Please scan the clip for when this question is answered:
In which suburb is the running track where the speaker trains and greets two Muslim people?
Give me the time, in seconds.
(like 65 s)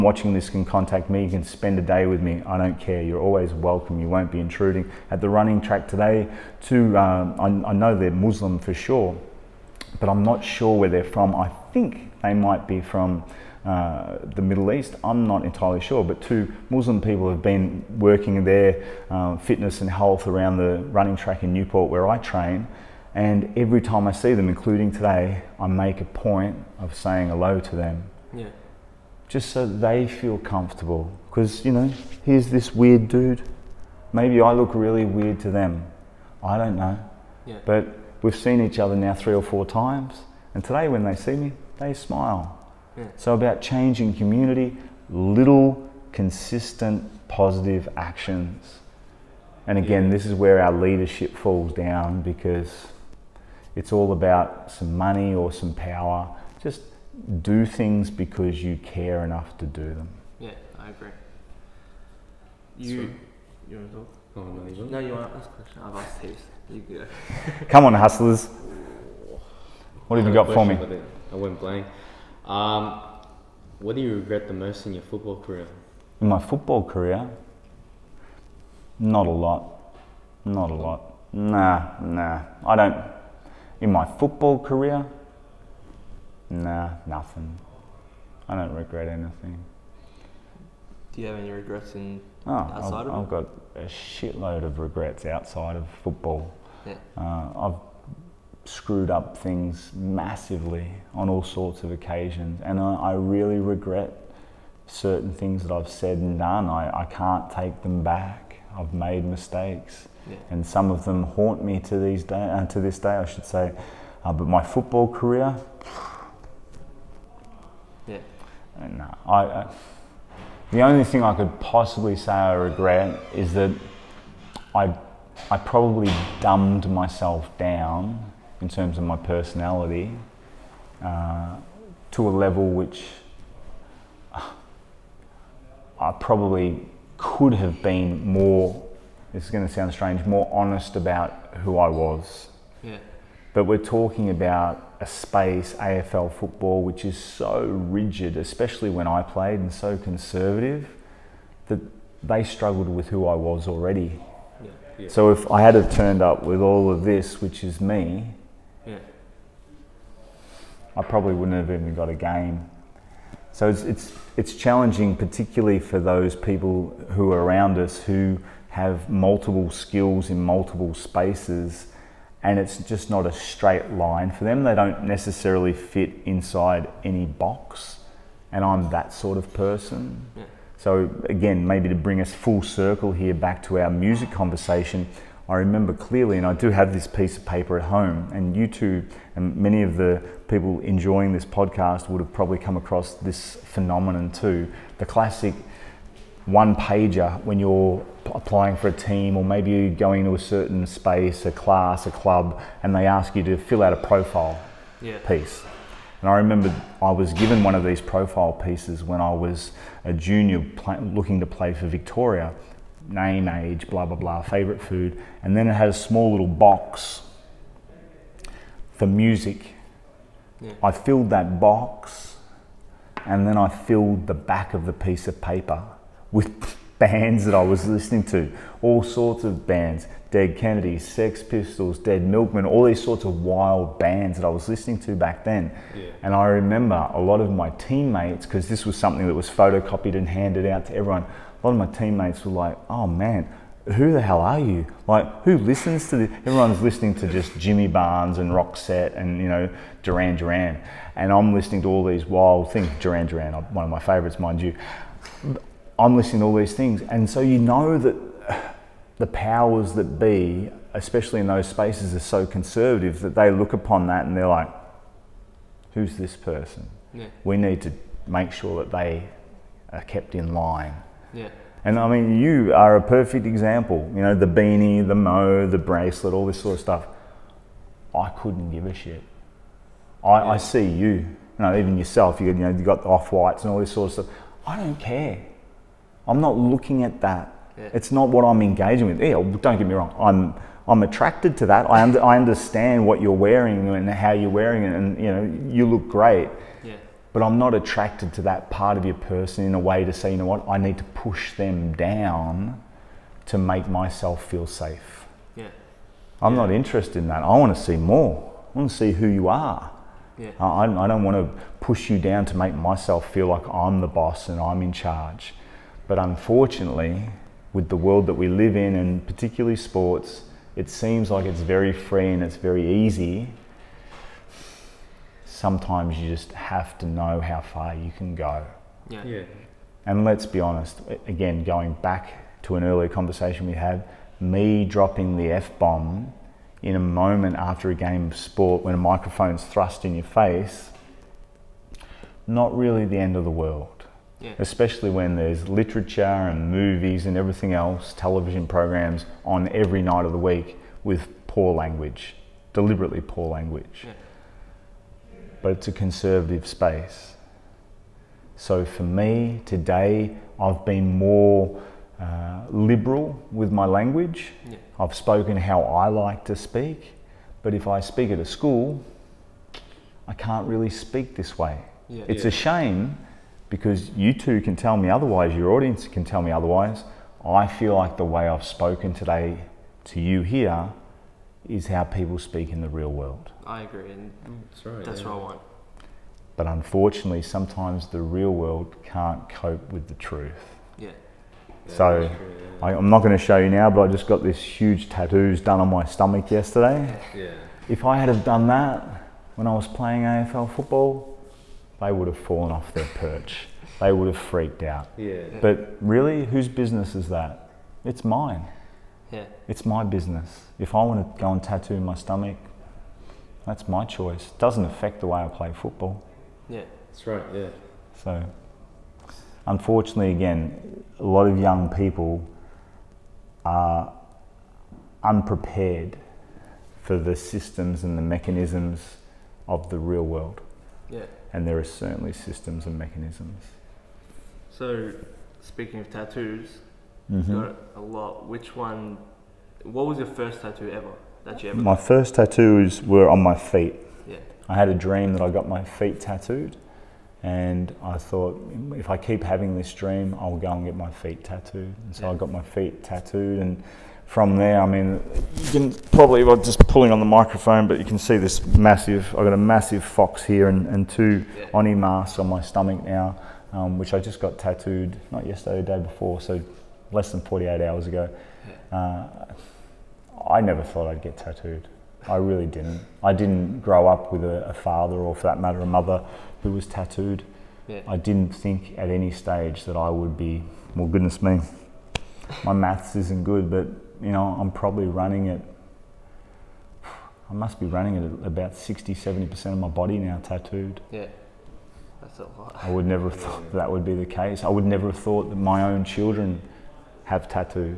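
21 s.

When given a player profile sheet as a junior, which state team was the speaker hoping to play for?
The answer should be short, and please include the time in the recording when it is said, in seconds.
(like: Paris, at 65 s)
Victoria, at 211 s.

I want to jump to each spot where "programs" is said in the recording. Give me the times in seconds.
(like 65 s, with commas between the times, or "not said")
348 s.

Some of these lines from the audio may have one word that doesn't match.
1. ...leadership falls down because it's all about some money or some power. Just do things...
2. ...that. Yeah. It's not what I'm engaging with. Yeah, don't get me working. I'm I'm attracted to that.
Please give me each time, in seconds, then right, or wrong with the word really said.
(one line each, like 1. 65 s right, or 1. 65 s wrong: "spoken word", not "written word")
1. 50 s right
2. 287 s wrong: "wrong", not "working".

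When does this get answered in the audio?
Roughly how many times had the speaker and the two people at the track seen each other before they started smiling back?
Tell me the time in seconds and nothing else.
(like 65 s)
39 s.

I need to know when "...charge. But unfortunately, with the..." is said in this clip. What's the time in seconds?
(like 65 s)
314 s.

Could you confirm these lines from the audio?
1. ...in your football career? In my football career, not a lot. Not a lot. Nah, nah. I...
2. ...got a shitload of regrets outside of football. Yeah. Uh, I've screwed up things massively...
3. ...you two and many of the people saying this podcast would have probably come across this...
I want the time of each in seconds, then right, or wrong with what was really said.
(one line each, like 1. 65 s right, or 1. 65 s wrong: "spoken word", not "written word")
1. 74 s right
2. 93 s right
3. 188 s wrong: "enjoying", not "saying".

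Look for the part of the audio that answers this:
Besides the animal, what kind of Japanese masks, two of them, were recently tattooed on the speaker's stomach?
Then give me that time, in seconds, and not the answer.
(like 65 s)
461 s.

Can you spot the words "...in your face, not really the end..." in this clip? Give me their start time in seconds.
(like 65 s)
340 s.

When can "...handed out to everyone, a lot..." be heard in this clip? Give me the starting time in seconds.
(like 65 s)
240 s.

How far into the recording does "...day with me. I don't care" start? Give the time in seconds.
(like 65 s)
1 s.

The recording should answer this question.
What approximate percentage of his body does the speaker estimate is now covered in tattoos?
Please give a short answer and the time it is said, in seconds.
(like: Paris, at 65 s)
60 to 70%, at 488 s.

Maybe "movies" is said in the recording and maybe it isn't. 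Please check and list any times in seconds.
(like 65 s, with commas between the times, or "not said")
346 s.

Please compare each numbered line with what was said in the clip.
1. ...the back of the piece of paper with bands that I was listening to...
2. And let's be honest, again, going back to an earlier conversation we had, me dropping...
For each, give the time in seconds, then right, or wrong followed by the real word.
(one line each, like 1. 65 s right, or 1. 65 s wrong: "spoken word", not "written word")
1. 224 s right
2. 330 s right.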